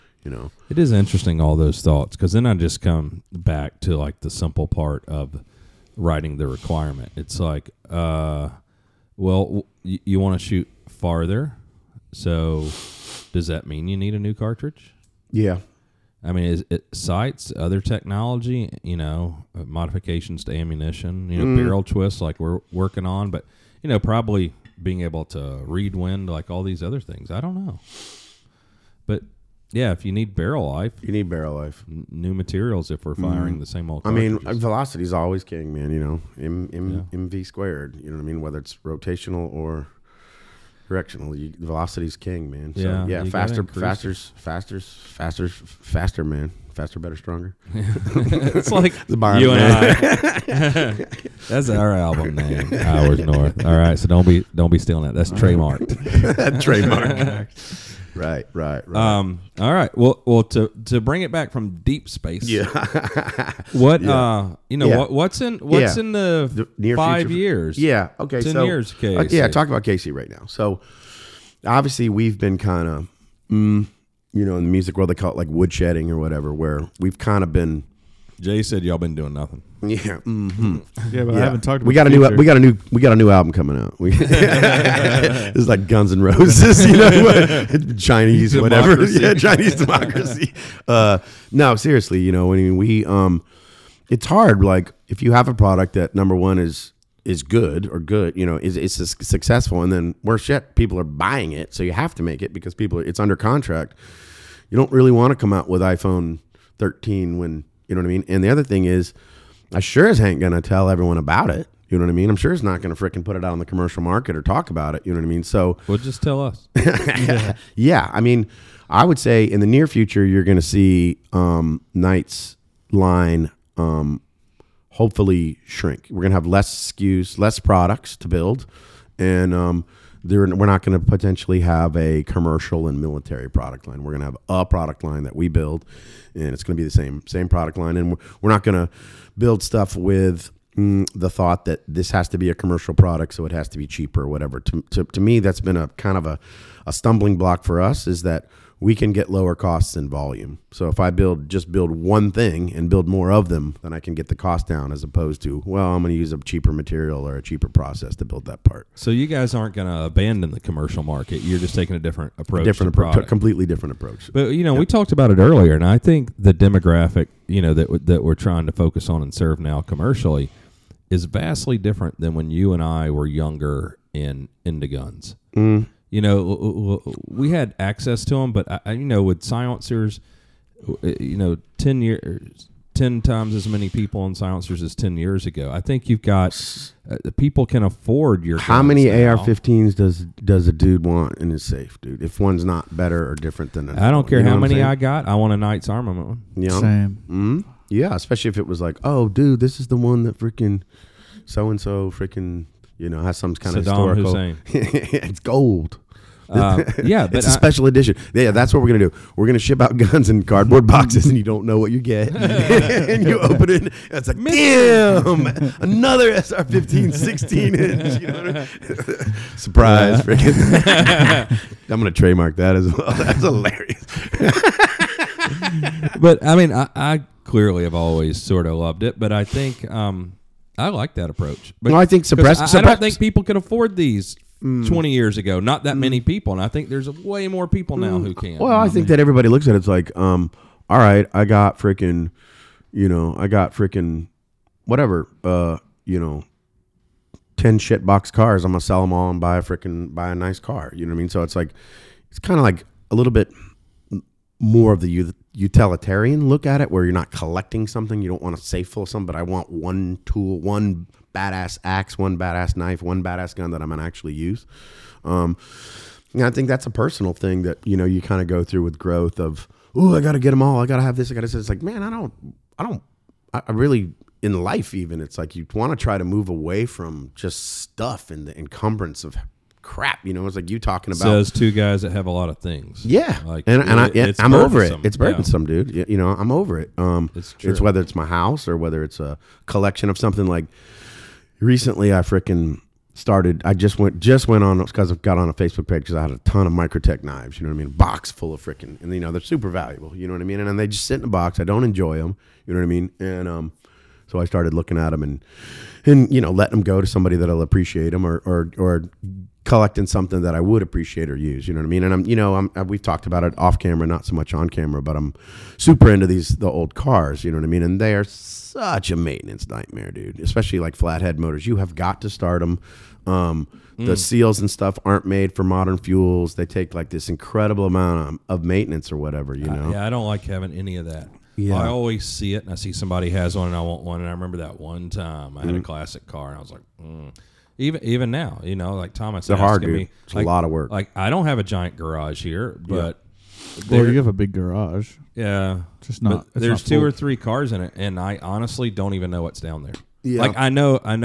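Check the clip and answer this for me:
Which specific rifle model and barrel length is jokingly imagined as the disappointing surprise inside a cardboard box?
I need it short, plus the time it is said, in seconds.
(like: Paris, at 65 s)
SR 15 16 inch, at 216 s.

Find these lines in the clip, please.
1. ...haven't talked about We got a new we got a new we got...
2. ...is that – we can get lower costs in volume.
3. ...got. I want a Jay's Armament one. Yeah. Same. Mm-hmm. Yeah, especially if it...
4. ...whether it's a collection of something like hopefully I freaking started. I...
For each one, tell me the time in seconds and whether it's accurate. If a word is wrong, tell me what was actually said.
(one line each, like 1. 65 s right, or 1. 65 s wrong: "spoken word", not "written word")
1. 81 s right
2. 148 s right
3. 194 s wrong: "Knight", not "Jay"
4. 288 s wrong: "recently", not "hopefully".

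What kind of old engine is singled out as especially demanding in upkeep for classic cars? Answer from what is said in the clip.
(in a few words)
Flathead motors.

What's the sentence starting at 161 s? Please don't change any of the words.
You're just taking a different approach.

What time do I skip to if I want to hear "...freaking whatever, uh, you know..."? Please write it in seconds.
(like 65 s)
243 s.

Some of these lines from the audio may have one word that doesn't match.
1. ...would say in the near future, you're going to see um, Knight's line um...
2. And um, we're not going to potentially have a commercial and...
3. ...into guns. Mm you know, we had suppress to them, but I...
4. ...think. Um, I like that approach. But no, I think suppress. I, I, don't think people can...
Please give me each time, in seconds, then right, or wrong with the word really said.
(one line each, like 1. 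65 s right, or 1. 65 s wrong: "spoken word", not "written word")
1. 119 s right
2. 129 s right
3. 174 s wrong: "access", not "suppress"
4. 229 s right.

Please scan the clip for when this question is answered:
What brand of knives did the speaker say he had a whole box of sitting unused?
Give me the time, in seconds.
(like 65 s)
296 s.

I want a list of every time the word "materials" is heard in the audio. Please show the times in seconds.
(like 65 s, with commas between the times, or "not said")
32 s, 156 s.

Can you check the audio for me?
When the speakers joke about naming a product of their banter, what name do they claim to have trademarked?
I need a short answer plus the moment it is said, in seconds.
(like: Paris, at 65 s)
Hours North, at 52 s.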